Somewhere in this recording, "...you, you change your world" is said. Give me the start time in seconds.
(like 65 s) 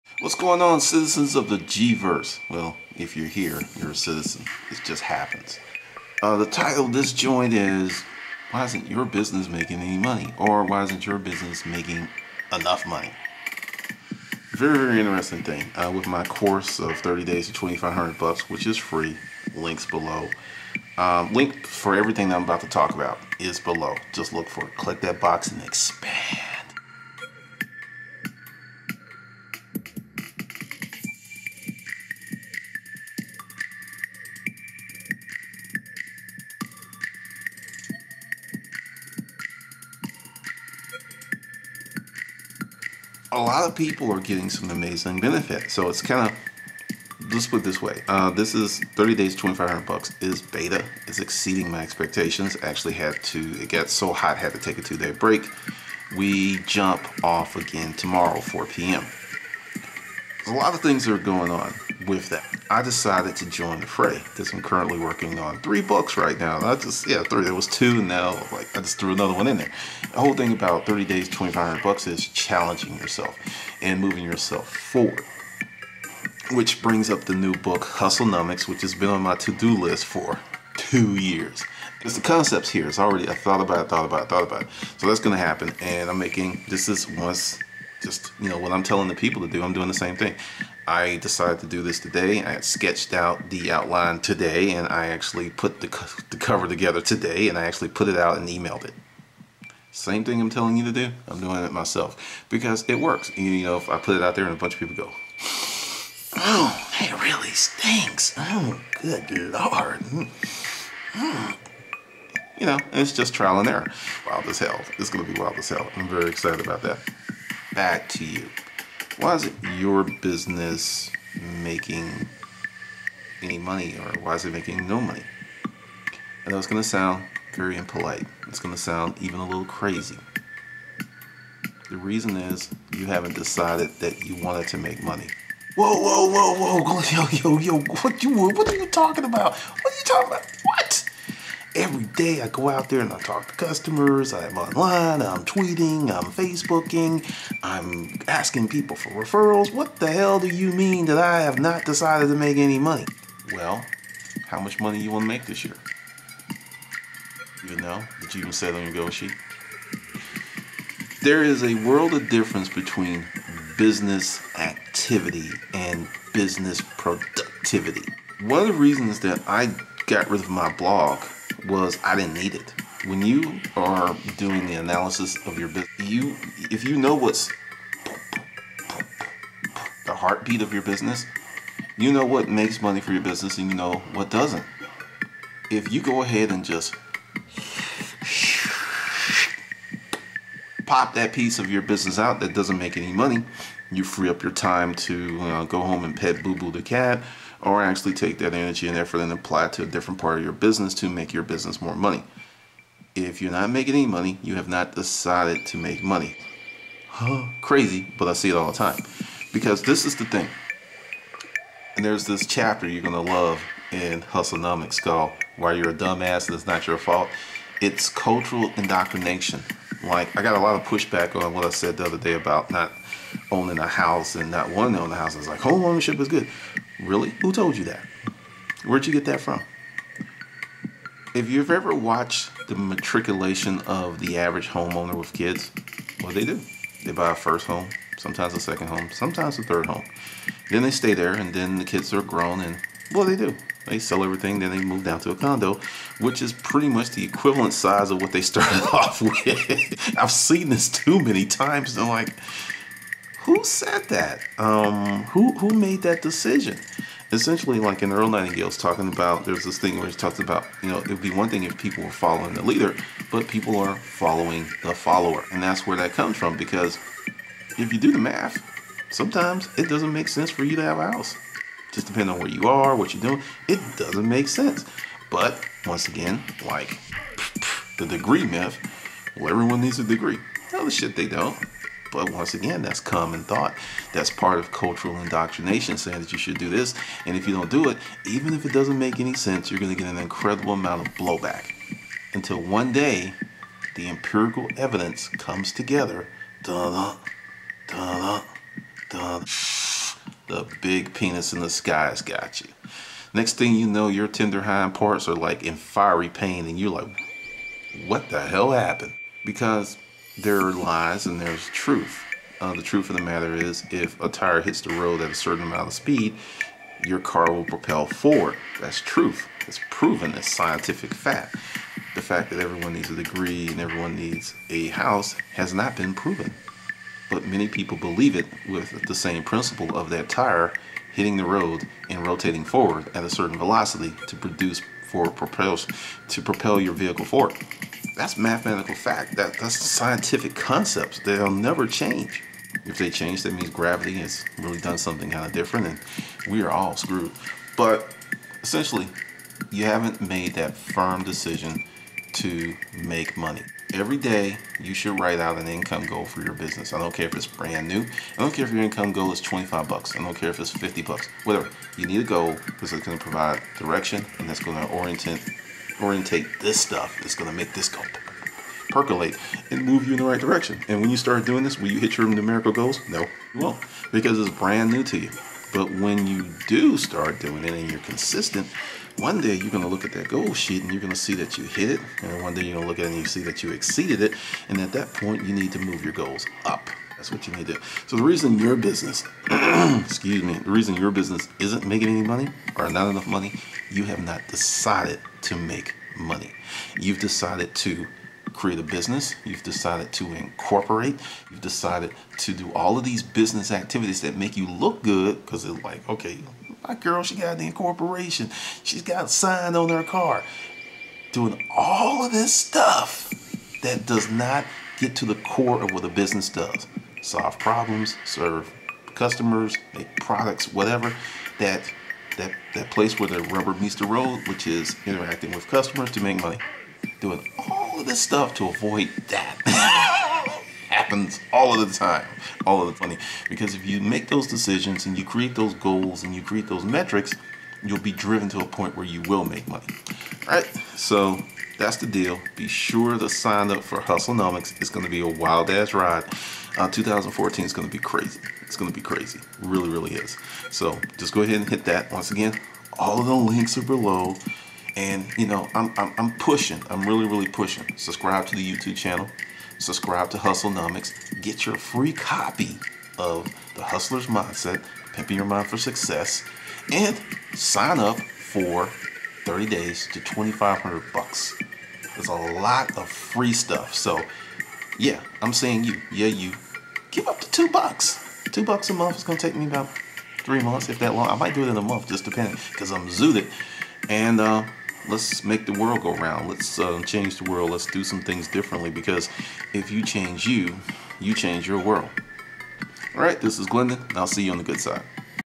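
490 s.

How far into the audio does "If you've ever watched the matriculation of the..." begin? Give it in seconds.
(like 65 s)
231 s.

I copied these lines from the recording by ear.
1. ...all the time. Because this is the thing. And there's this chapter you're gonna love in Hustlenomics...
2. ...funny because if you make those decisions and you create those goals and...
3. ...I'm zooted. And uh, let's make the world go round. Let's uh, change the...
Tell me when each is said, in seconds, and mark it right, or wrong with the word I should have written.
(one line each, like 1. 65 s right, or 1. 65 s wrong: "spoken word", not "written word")
1. 208 s right
2. 432 s right
3. 482 s right.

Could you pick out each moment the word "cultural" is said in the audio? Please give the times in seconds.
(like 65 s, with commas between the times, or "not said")
218 s, 284 s.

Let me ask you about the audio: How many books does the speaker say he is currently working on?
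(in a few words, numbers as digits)
3.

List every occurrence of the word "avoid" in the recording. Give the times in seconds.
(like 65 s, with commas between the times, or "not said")
428 s.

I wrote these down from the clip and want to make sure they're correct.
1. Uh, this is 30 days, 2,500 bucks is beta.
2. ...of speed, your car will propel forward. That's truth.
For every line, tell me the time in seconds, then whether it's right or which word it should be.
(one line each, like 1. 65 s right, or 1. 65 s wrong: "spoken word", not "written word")
1. 48 s right
2. 315 s right.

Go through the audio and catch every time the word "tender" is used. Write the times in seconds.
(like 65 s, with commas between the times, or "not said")
304 s.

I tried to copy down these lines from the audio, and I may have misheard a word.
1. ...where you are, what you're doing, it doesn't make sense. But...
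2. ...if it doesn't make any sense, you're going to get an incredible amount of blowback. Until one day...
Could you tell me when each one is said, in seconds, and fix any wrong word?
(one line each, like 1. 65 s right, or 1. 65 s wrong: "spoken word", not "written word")
1. 272 s right
2. 288 s right.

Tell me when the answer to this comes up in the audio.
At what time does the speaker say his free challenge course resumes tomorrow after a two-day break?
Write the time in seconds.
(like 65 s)
58 s.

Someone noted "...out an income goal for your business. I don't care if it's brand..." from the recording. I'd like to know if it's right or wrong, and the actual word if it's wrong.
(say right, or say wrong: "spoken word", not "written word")
right.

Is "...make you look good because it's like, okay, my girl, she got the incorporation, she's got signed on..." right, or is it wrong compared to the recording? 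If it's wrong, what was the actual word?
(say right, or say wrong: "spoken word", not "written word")
right.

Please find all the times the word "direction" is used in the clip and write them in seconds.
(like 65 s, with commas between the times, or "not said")
363 s, 370 s.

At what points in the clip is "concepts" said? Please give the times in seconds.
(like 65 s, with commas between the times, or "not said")
82 s, 340 s.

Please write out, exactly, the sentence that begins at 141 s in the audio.
every day I go out there and I talk to customers, I'm online, I'm tweeting, I'm Facebooking, I'm asking people for referrals.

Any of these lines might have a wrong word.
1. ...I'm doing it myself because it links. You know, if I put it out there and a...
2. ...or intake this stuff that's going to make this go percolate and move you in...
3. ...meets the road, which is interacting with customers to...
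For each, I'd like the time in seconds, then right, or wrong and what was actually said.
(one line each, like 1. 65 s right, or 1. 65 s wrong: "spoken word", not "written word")
1. 101 s wrong: "works", not "links"
2. 366 s right
3. 423 s right.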